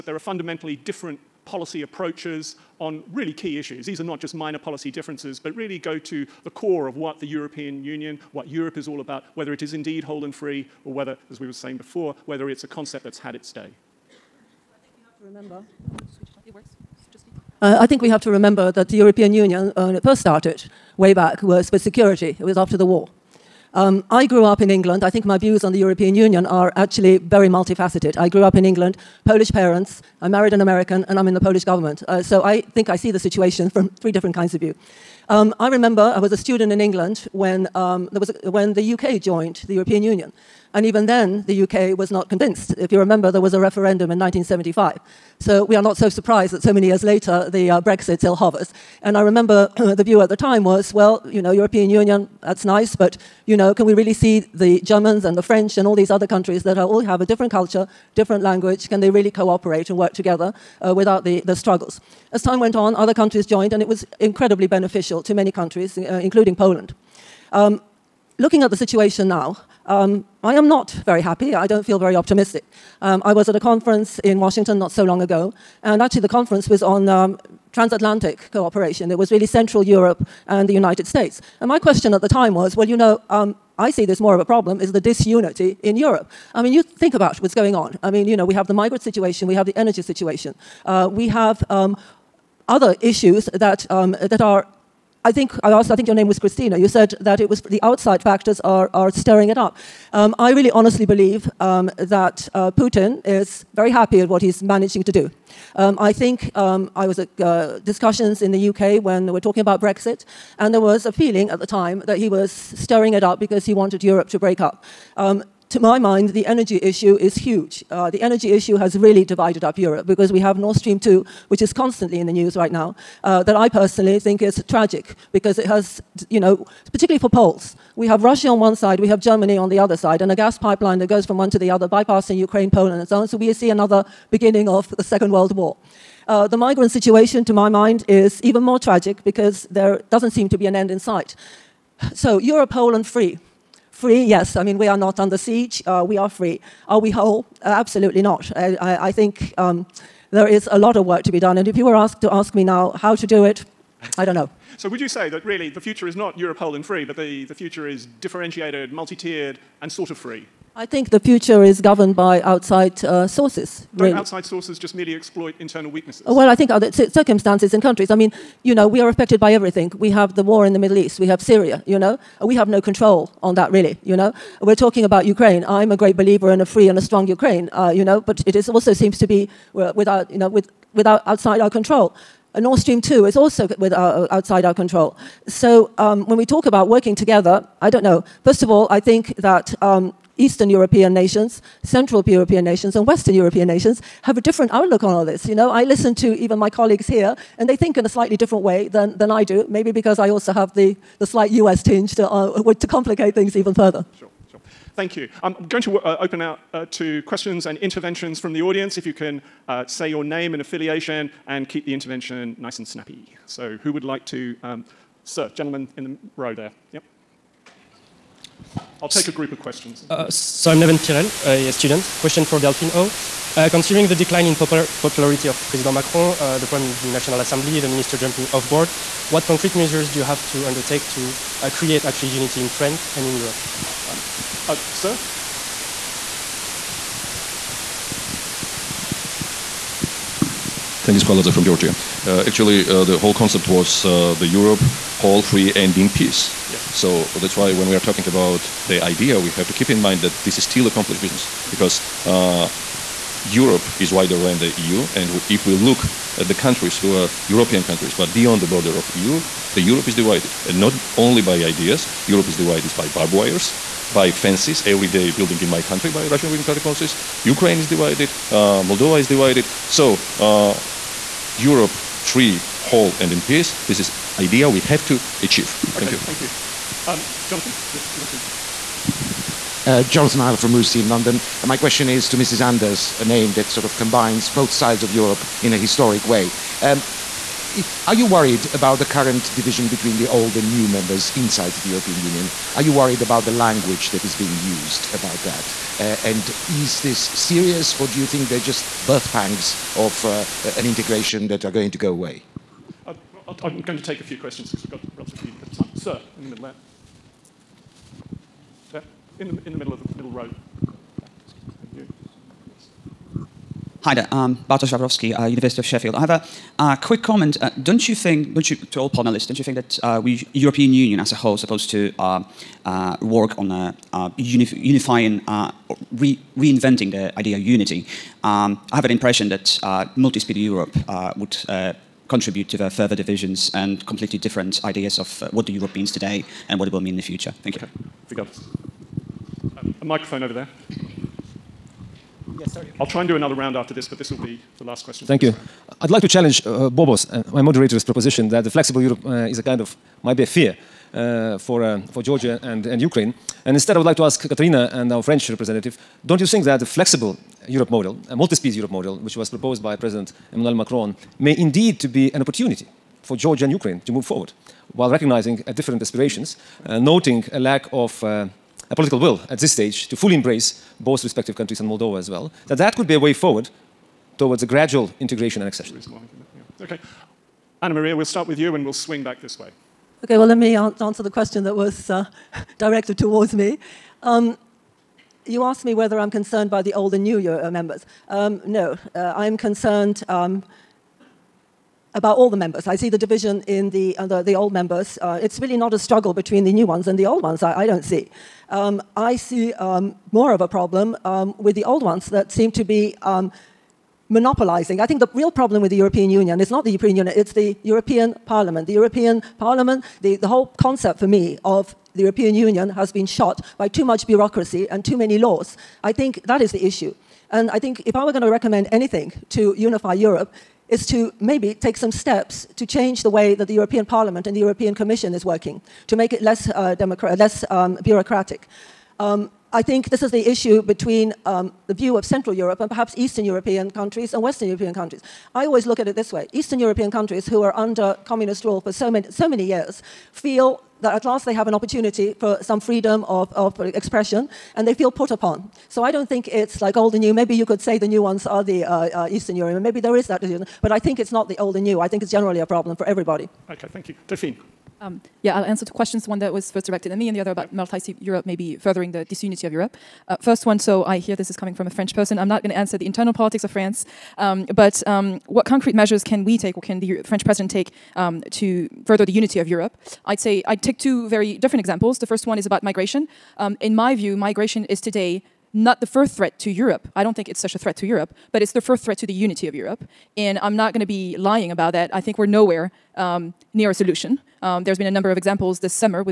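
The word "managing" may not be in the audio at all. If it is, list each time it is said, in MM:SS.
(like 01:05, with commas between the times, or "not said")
01:44.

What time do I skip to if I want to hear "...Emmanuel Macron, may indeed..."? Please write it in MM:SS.
06:00.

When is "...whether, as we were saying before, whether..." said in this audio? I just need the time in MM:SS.
00:10.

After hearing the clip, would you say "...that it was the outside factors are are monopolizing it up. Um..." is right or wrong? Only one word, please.
wrong.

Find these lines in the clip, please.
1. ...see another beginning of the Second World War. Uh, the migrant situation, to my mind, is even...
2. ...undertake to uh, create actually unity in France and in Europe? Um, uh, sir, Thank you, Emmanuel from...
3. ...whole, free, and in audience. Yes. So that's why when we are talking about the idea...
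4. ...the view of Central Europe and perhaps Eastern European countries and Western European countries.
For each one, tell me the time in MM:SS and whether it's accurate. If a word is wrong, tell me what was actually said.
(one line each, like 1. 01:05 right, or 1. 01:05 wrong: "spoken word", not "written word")
1. 02:13 right
2. 03:50 wrong: "Paladze", not "Emmanuel"
3. 04:05 wrong: "peace", not "audience"
4. 07:11 right.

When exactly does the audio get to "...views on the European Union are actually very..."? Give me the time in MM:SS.
00:25.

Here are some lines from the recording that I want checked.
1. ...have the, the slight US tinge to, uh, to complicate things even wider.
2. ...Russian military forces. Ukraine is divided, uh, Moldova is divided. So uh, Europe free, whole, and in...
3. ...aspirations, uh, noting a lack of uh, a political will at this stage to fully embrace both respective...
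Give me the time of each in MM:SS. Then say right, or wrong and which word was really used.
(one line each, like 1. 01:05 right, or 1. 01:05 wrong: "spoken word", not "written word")
1. 03:20 wrong: "further", not "wider"
2. 04:26 right
3. 06:06 right.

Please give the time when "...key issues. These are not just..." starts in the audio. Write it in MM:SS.
00:03.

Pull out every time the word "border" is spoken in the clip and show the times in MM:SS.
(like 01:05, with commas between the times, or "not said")
04:18.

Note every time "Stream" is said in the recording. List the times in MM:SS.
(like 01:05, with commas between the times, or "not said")
02:00, 03:02.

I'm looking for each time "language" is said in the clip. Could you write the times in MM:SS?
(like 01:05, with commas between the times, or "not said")
00:58, 04:53.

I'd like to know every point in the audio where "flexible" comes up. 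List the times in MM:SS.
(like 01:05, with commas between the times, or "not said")
05:48, 05:56.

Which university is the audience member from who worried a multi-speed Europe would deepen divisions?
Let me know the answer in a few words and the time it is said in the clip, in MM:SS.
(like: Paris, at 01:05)
University of Sheffield, at 05:15.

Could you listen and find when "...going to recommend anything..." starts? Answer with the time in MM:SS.
06:58.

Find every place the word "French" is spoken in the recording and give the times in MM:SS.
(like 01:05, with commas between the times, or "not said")
00:55, 05:55, 07:41, 07:47.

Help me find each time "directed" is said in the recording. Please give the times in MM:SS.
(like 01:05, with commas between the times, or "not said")
06:22, 07:36.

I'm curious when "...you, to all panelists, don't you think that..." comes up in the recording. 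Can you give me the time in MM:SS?
05:18.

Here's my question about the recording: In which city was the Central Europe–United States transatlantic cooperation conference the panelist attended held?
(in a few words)
Washington.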